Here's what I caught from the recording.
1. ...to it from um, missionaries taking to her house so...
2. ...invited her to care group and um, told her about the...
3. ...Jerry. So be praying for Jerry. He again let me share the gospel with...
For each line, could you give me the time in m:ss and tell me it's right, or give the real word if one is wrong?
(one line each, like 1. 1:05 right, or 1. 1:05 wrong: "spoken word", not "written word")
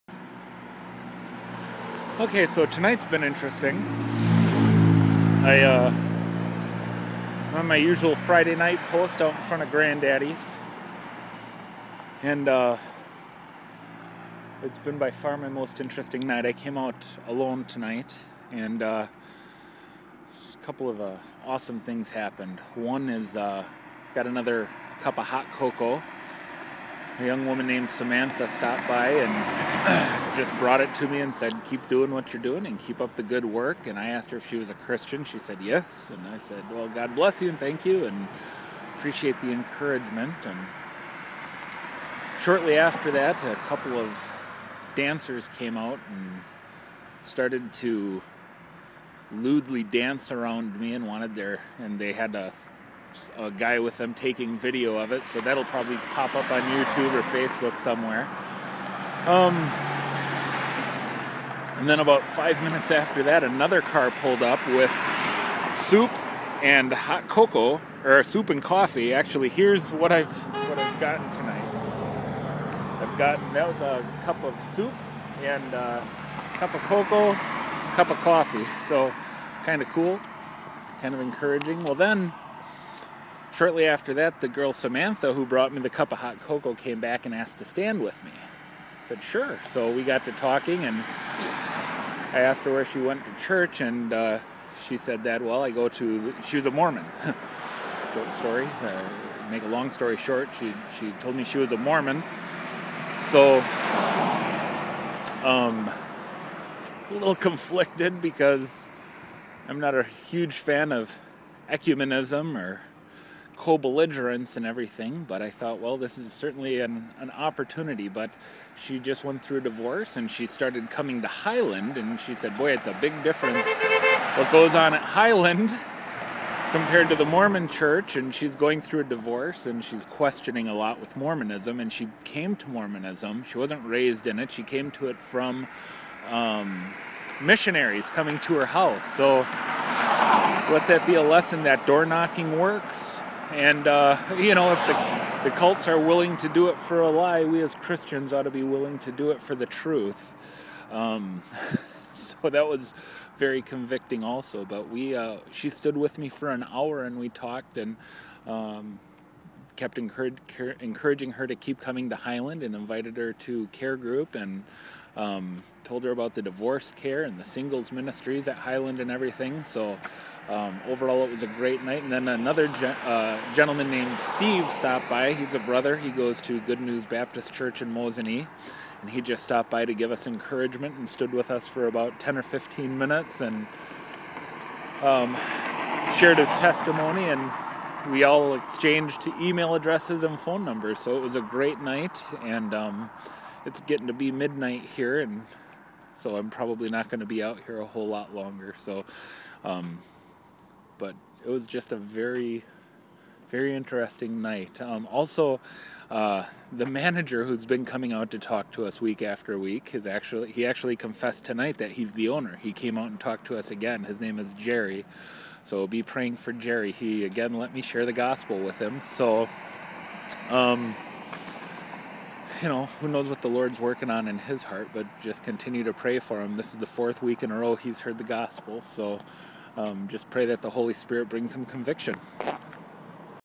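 1. 2:14 wrong: "coming", not "taking"
2. 2:42 right
3. 3:34 right.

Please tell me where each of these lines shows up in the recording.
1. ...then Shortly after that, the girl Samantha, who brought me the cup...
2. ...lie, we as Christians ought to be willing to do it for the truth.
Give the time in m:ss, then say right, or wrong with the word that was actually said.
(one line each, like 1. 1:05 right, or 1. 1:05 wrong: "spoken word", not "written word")
1. 1:21 right
2. 2:27 right.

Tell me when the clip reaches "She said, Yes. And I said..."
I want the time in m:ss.
0:35.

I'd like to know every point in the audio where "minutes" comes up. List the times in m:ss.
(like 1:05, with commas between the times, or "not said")
1:02, 3:02.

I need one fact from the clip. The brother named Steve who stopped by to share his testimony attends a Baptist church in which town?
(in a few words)
Mosinee.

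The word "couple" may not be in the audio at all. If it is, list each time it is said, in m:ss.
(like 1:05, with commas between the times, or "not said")
0:20, 0:43.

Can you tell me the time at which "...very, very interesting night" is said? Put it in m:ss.
3:21.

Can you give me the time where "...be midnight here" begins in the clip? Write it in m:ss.
3:14.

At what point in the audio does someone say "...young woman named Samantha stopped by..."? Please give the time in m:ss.
0:27.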